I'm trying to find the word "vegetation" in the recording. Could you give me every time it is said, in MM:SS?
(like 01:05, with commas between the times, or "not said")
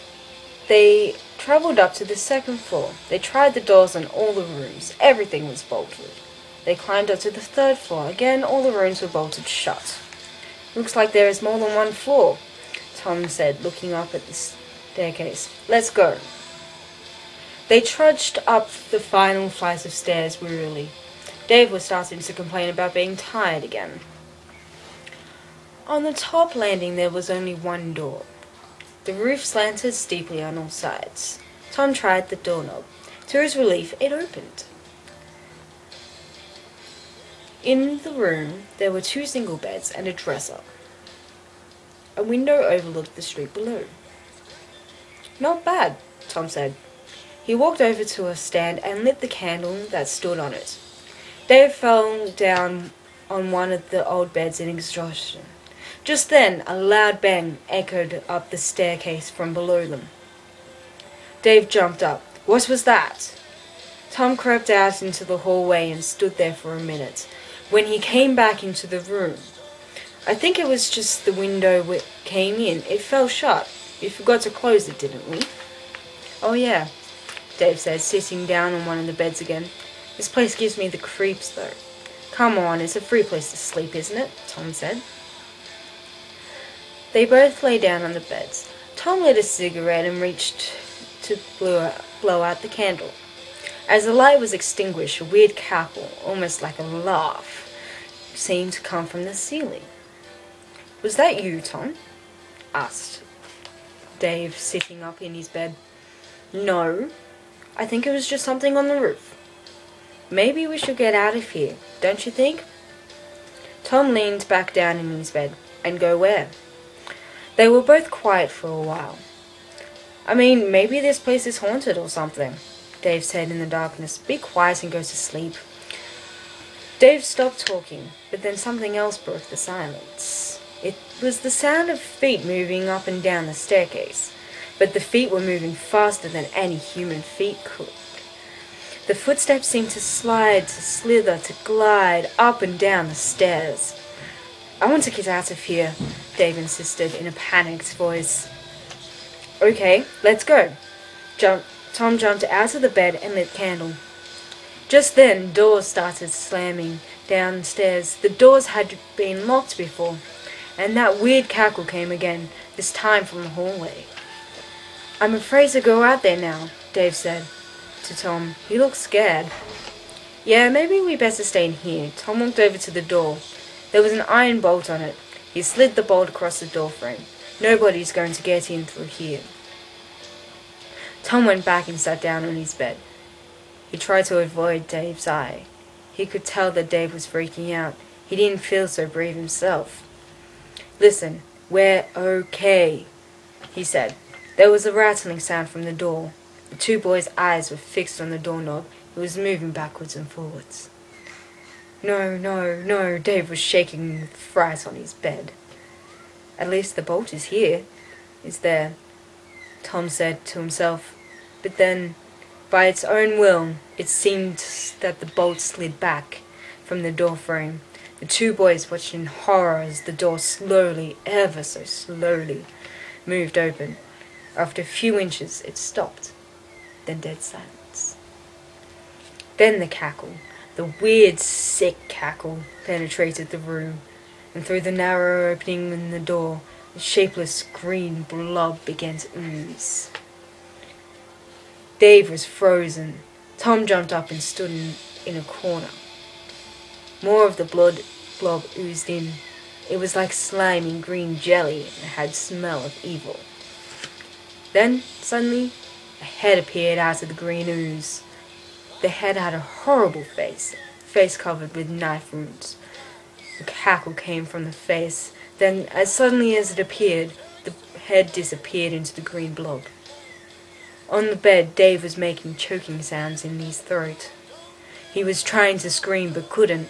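not said.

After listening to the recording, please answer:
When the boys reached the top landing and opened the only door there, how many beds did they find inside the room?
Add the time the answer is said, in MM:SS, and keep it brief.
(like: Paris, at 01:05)
2, at 00:39.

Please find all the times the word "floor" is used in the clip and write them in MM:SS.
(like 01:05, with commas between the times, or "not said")
00:02, 00:07, 00:11.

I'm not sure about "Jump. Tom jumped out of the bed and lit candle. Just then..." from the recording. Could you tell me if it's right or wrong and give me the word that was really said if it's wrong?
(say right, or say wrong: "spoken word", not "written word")
right.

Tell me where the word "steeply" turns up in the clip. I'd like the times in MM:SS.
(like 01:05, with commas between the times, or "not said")
00:29.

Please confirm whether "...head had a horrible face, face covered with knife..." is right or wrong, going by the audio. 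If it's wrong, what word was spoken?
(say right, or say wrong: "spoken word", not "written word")
right.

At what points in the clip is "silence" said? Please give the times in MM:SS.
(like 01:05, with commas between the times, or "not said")
02:09, 03:47.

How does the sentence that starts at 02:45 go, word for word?
I'm afraid to go out there now, Dave said to Tom.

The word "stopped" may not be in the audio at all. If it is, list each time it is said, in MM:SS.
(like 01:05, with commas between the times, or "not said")
02:07, 03:45.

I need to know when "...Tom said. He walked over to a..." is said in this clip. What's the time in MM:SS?
00:46.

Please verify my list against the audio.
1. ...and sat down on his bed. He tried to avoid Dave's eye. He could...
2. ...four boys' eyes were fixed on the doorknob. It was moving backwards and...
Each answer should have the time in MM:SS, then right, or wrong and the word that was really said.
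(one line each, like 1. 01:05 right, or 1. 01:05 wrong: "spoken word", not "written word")
1. 03:01 right
2. 03:16 wrong: "two", not "four".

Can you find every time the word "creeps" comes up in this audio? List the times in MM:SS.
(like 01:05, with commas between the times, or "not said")
01:20.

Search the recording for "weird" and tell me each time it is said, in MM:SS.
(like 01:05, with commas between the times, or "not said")
01:35, 02:41, 03:51.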